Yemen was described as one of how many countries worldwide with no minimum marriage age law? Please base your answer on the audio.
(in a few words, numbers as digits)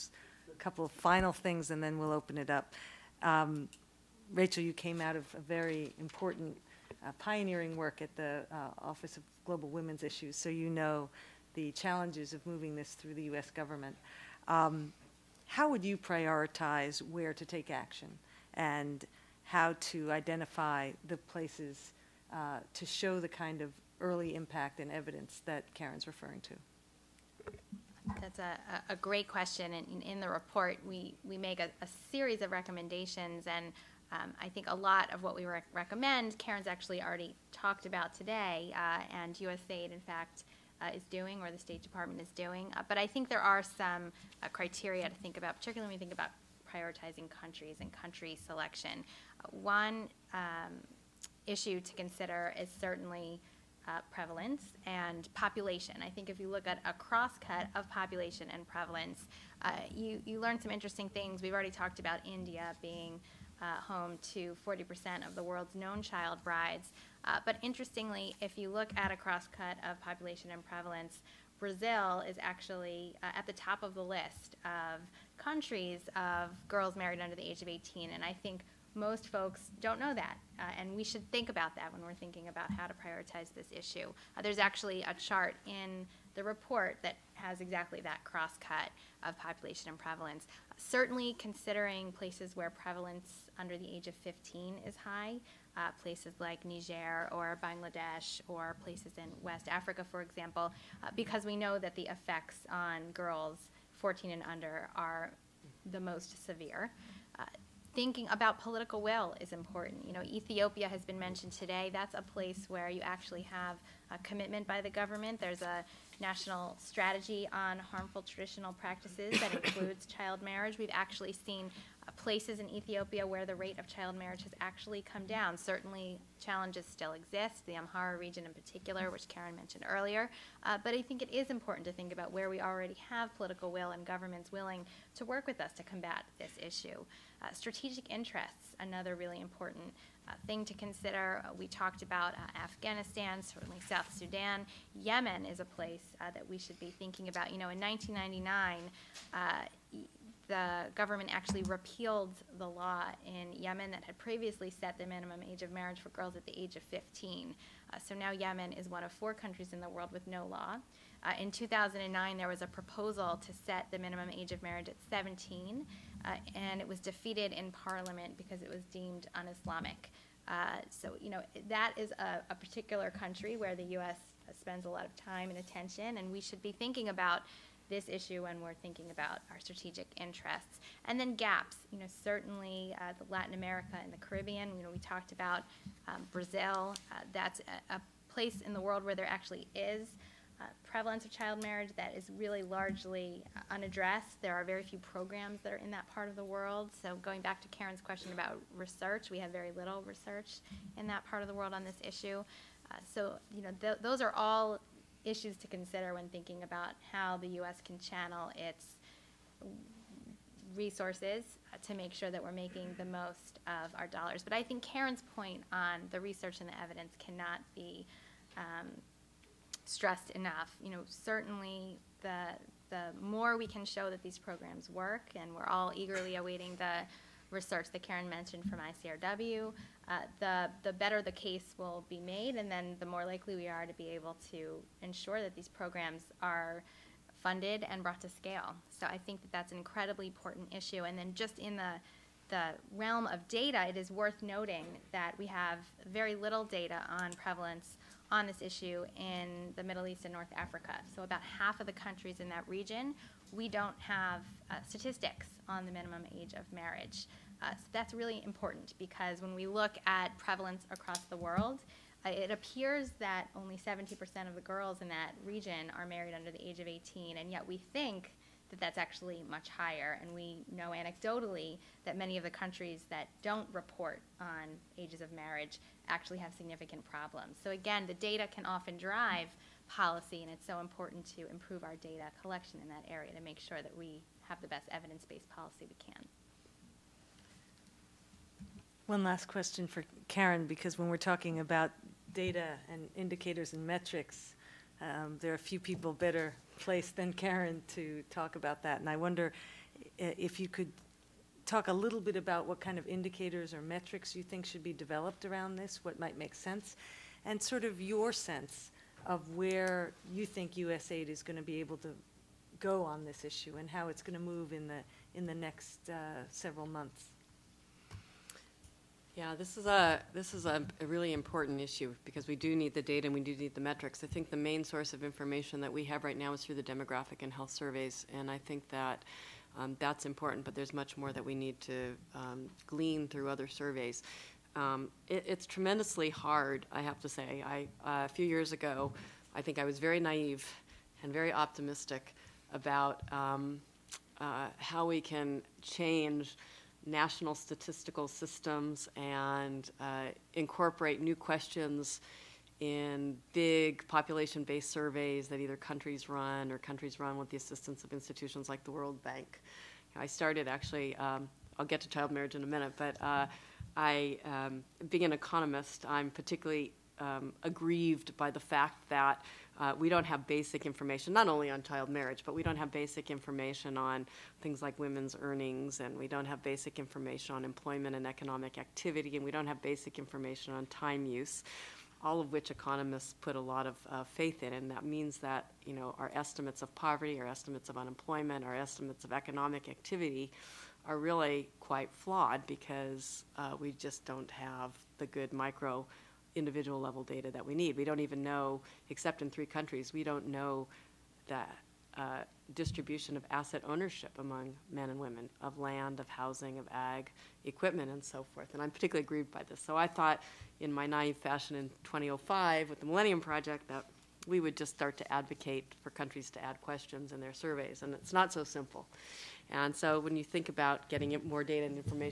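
4.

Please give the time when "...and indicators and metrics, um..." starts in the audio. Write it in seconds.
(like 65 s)
292 s.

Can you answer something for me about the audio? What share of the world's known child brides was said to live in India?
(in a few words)
40%.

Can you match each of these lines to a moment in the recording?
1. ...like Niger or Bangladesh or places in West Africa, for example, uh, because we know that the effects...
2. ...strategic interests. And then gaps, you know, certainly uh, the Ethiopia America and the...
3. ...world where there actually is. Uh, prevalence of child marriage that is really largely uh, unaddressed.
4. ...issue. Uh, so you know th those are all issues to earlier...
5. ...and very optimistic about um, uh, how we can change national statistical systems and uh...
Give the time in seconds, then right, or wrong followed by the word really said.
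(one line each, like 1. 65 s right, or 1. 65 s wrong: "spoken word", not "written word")
1. 96 s right
2. 179 s wrong: "Latin", not "Ethiopia"
3. 188 s right
4. 202 s wrong: "consider", not "earlier"
5. 341 s right.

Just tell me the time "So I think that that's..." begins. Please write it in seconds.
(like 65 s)
238 s.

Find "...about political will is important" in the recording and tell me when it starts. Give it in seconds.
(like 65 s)
108 s.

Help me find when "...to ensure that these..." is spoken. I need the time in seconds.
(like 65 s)
234 s.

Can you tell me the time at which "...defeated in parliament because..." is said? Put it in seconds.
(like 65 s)
166 s.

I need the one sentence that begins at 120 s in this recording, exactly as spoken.
We've actually seen uh, places in Ethiopia where the rate of child marriage has actually come down.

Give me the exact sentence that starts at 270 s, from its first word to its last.
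And we know anecdotally that many of the countries that don't report on ages of marriage actually have significant problems.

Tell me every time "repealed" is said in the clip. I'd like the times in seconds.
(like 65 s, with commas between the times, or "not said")
151 s.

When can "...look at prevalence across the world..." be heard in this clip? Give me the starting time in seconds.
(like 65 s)
259 s.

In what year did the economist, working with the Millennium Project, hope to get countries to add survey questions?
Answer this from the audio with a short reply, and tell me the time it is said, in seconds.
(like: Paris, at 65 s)
2005, at 412 s.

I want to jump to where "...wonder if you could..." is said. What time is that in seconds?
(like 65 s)
299 s.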